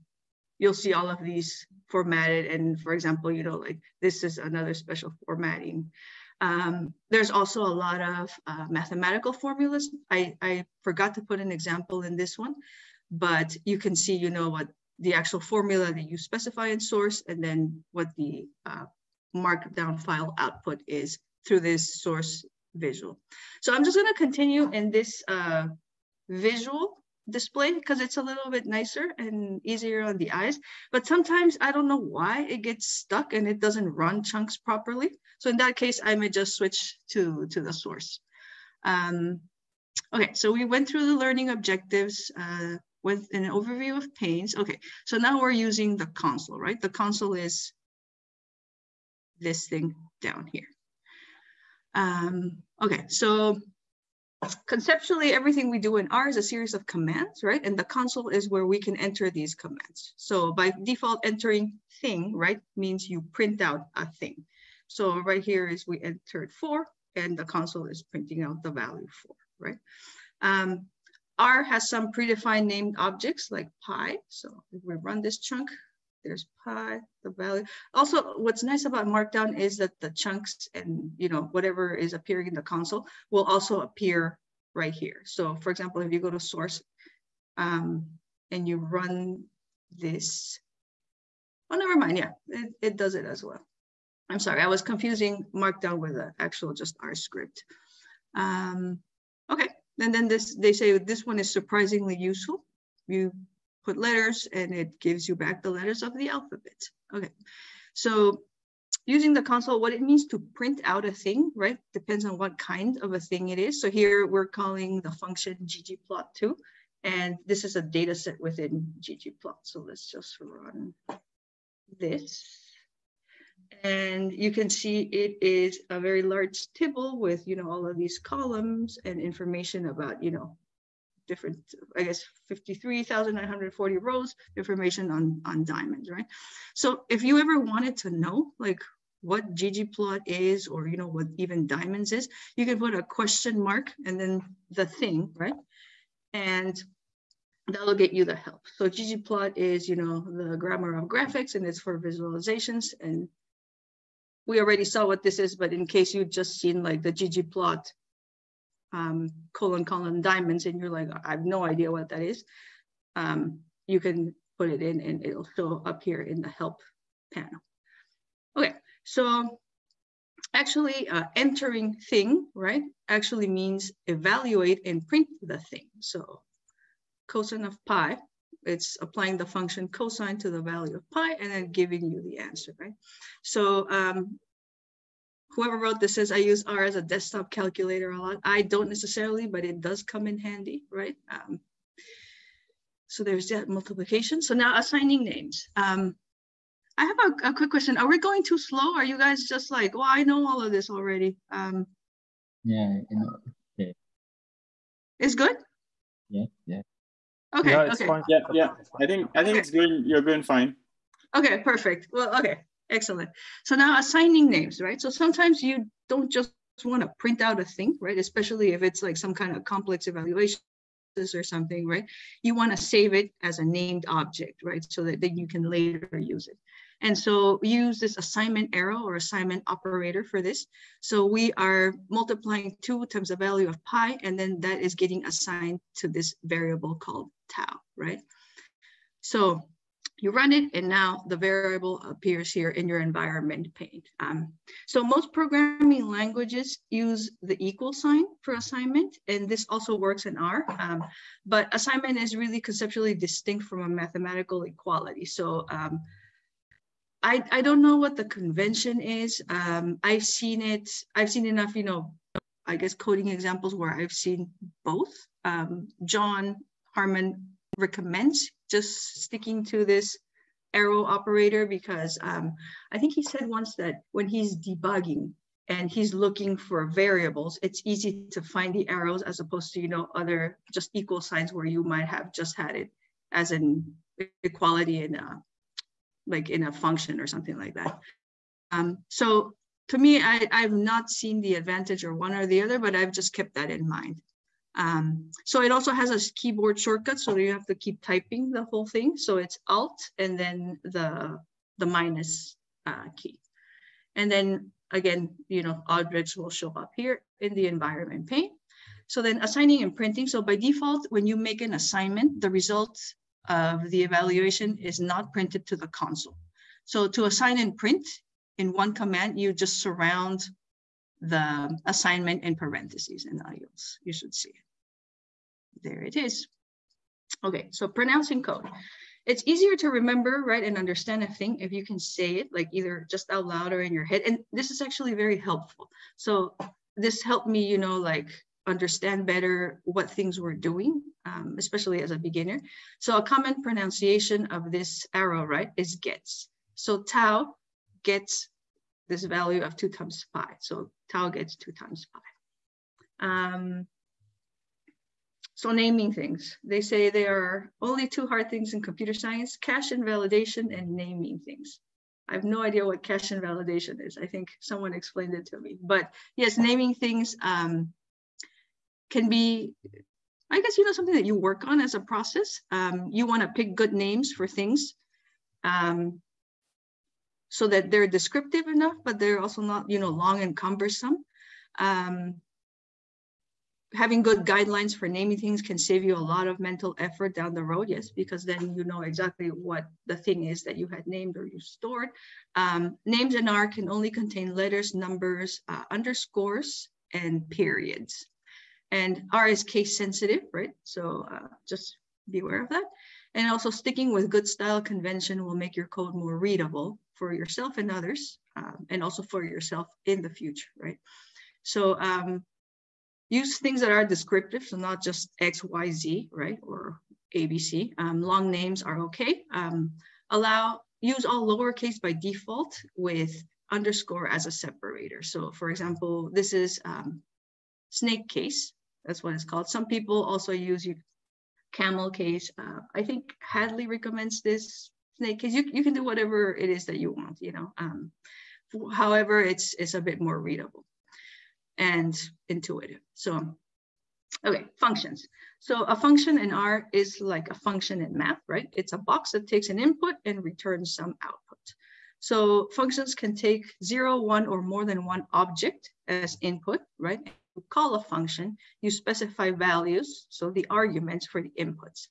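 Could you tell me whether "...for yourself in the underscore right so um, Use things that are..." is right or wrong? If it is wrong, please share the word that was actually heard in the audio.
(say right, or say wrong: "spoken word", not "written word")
wrong: "future", not "underscore".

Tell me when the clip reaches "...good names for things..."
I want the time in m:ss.
6:13.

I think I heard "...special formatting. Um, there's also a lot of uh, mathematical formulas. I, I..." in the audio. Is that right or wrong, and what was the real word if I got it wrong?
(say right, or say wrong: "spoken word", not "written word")
right.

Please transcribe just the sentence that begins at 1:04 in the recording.
So right here is we entered four and the console is printing out the value four, right?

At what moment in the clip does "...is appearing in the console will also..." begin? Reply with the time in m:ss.
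1:21.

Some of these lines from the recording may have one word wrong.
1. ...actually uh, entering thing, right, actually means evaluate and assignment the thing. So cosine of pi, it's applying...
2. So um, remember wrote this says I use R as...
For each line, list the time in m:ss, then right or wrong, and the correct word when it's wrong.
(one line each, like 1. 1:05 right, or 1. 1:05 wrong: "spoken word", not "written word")
1. 2:50 wrong: "print", not "assignment"
2. 3:03 wrong: "whoever", not "remember".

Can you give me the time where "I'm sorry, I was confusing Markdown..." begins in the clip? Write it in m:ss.
1:34.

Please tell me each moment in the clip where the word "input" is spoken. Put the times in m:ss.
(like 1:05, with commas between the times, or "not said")
7:29, 7:36, 7:41.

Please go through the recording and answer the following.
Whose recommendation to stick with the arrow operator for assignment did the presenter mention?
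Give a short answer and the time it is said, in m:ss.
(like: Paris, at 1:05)
Jon Harmon, at 4:26.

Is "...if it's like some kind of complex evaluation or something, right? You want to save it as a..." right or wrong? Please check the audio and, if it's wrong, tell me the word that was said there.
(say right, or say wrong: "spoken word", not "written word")
right.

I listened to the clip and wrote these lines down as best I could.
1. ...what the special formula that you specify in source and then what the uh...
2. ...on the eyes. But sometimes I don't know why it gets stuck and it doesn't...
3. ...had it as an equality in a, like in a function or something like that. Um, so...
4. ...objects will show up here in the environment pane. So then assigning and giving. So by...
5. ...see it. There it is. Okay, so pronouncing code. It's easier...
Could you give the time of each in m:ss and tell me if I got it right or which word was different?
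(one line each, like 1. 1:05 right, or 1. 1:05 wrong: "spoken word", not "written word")
1. 0:14 wrong: "actual", not "special"
2. 0:30 right
3. 4:42 right
4. 5:05 wrong: "printing", not "giving"
5. 5:24 right.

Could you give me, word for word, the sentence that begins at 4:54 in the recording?
Um, so it also has a keyboard shortcut, so you have to keep typing the whole thing.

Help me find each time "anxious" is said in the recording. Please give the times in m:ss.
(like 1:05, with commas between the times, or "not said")
not said.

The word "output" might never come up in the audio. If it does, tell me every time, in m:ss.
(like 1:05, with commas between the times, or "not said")
0:20, 7:31.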